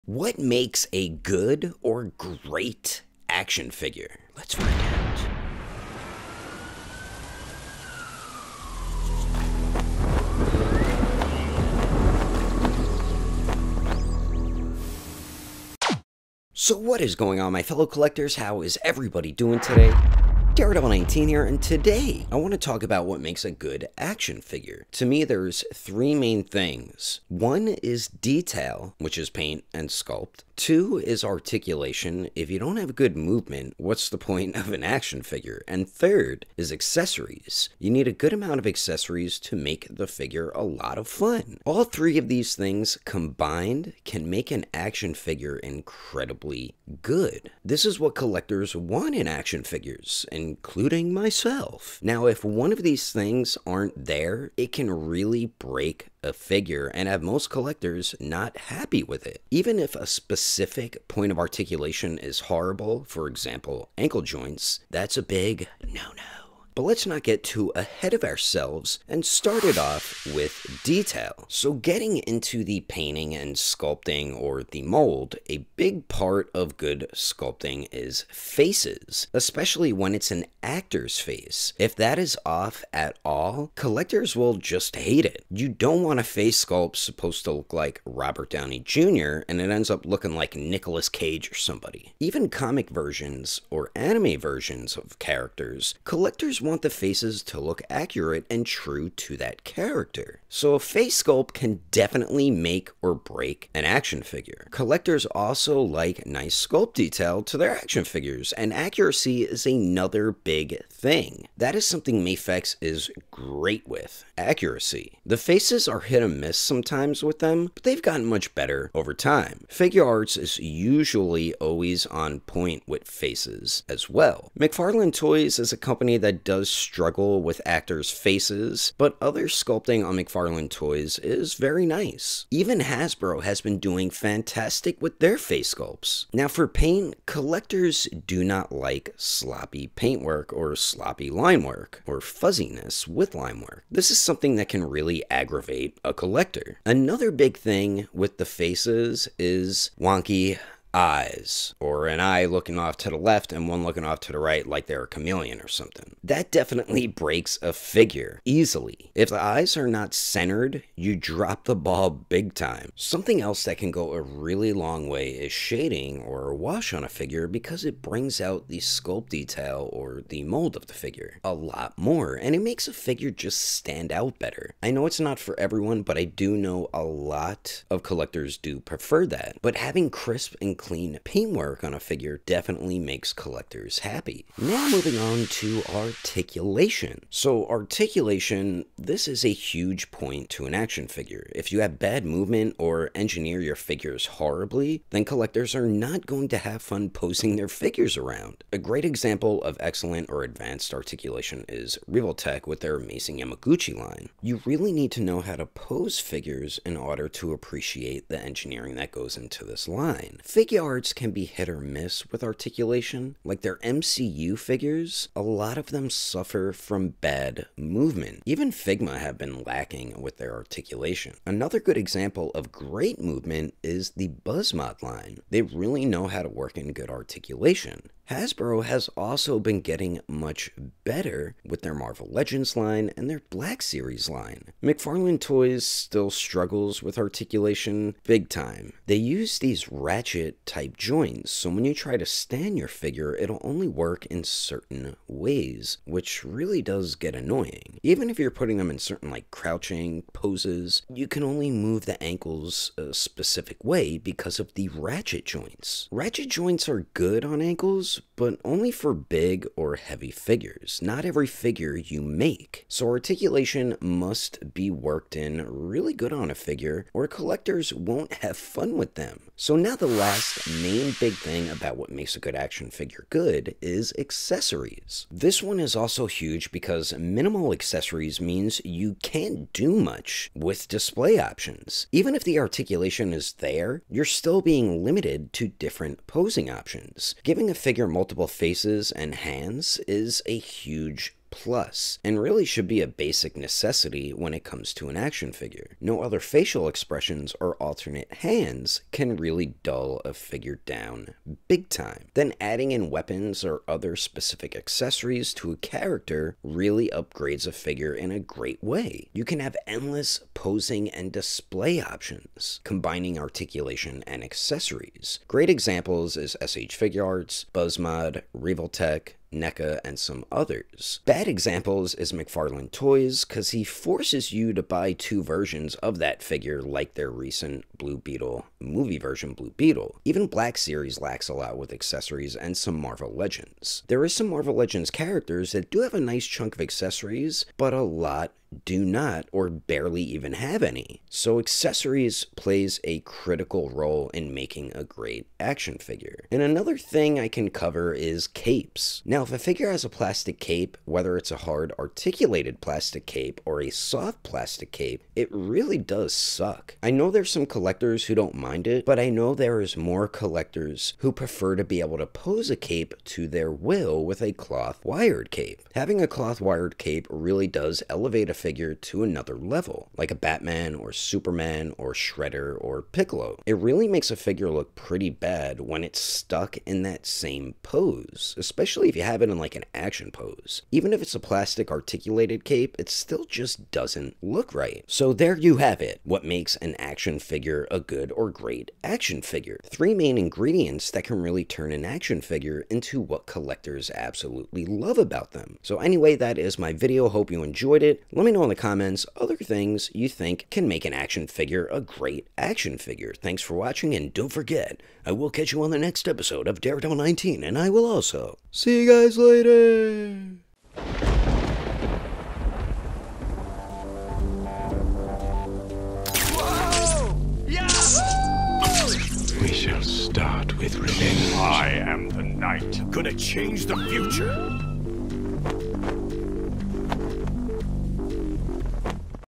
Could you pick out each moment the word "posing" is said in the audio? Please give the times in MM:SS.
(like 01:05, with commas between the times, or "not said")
03:17, 04:46, 05:10.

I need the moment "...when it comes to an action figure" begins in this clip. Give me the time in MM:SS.
04:54.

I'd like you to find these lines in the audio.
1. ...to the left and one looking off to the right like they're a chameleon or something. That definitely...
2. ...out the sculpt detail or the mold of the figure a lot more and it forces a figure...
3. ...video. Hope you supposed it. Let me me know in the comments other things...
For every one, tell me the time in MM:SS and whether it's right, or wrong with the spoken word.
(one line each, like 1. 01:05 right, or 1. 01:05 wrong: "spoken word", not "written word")
1. 02:32 right
2. 02:48 wrong: "makes", not "forces"
3. 06:36 wrong: "enjoyed", not "supposed".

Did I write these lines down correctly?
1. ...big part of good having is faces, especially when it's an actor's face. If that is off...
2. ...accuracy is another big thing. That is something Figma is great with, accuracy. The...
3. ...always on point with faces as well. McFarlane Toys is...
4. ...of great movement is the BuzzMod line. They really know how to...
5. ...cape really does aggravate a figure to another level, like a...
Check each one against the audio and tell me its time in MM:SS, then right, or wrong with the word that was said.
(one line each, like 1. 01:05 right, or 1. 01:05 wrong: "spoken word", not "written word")
1. 01:15 wrong: "sculpting", not "having"
2. 01:48 wrong: "Mafex", not "Figma"
3. 02:01 right
4. 03:42 right
5. 06:06 wrong: "elevate", not "aggravate".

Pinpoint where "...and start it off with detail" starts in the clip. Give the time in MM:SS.
01:09.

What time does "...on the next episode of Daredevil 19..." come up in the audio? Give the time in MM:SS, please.
06:45.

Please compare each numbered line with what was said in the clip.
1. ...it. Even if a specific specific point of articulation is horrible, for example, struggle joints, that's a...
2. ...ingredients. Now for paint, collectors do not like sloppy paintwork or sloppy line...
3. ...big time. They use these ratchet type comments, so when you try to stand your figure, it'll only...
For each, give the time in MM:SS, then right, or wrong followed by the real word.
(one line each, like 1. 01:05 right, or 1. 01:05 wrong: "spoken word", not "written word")
1. 00:59 wrong: "ankle", not "struggle"
2. 02:15 wrong: "sculpts", not "ingredients"
3. 03:58 wrong: "joints", not "comments".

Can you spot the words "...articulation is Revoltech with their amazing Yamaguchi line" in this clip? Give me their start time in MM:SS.
03:20.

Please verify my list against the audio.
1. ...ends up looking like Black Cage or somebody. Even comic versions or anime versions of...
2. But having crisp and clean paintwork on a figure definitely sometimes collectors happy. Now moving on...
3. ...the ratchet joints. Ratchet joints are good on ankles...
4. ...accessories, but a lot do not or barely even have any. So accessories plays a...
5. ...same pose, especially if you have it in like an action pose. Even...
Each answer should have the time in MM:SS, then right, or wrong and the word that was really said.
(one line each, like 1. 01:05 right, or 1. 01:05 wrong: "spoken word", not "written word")
1. 01:29 wrong: "Nicolas", not "Black"
2. 02:59 wrong: "makes", not "sometimes"
3. 04:14 right
4. 05:36 right
5. 06:17 right.